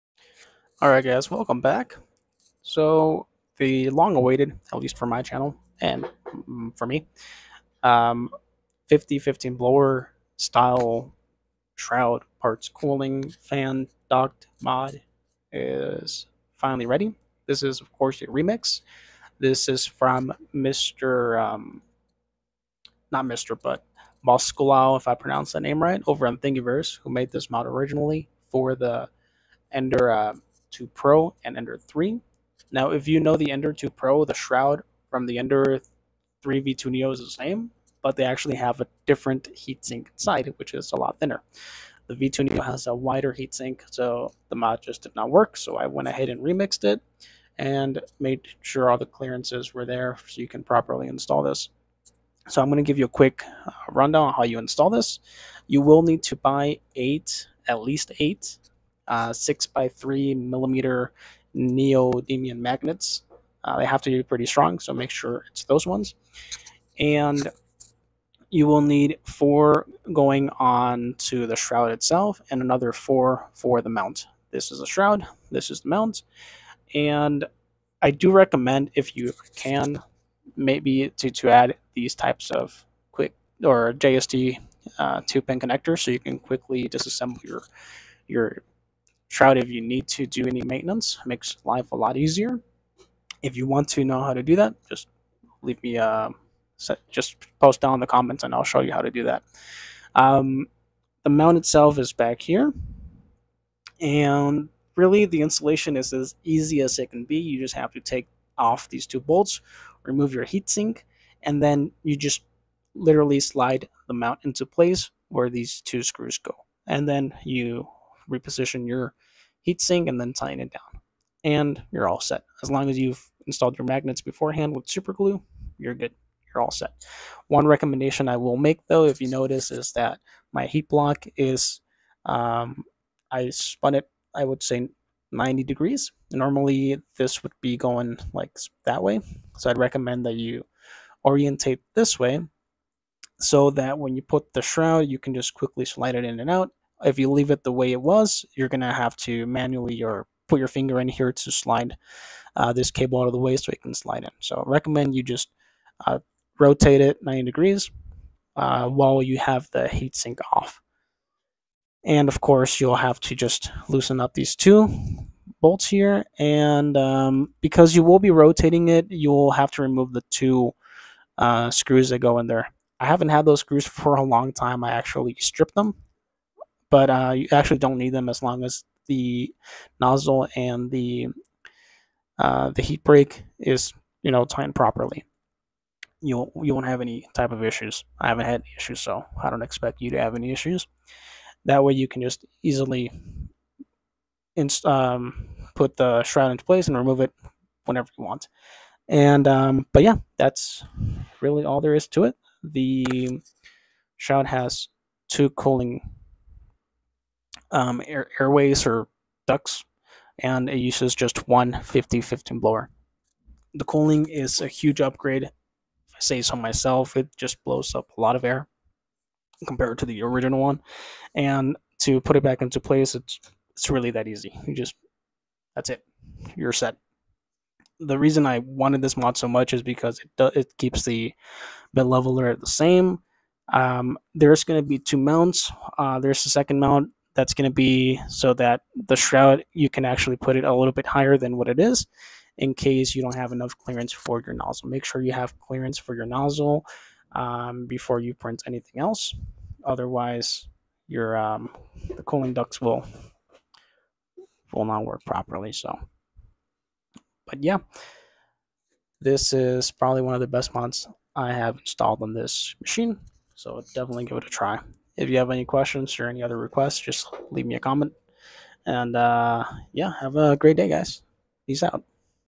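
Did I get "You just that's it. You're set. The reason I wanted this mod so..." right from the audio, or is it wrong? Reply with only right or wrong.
right.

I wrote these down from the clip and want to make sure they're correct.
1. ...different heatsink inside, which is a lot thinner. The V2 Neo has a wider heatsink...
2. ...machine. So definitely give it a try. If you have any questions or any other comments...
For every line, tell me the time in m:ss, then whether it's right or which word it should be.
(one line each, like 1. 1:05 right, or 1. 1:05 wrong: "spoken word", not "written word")
1. 0:39 right
2. 4:22 wrong: "requests", not "comments".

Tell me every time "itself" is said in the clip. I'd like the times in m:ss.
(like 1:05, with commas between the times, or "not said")
1:11, 1:41.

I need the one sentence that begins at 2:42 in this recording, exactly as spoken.
And of course, you'll have to just loosen up these two bolts here.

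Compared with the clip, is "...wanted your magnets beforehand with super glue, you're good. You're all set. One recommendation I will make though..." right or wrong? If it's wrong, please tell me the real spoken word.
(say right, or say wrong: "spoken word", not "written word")
wrong: "installed", not "wanted".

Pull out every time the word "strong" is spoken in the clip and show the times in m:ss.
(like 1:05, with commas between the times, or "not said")
1:04.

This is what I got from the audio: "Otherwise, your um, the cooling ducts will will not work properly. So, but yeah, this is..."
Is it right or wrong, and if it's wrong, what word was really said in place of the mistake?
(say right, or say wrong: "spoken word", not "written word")
right.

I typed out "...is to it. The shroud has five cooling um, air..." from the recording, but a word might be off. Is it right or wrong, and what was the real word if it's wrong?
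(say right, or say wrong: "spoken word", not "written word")
wrong: "two", not "five".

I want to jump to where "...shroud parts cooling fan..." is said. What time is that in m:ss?
0:11.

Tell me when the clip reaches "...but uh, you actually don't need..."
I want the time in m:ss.
2:56.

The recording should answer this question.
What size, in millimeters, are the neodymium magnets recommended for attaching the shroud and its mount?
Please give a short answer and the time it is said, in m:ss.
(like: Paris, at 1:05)
6 by 3 millimeter, at 0:59.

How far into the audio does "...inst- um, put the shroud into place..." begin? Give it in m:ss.
3:14.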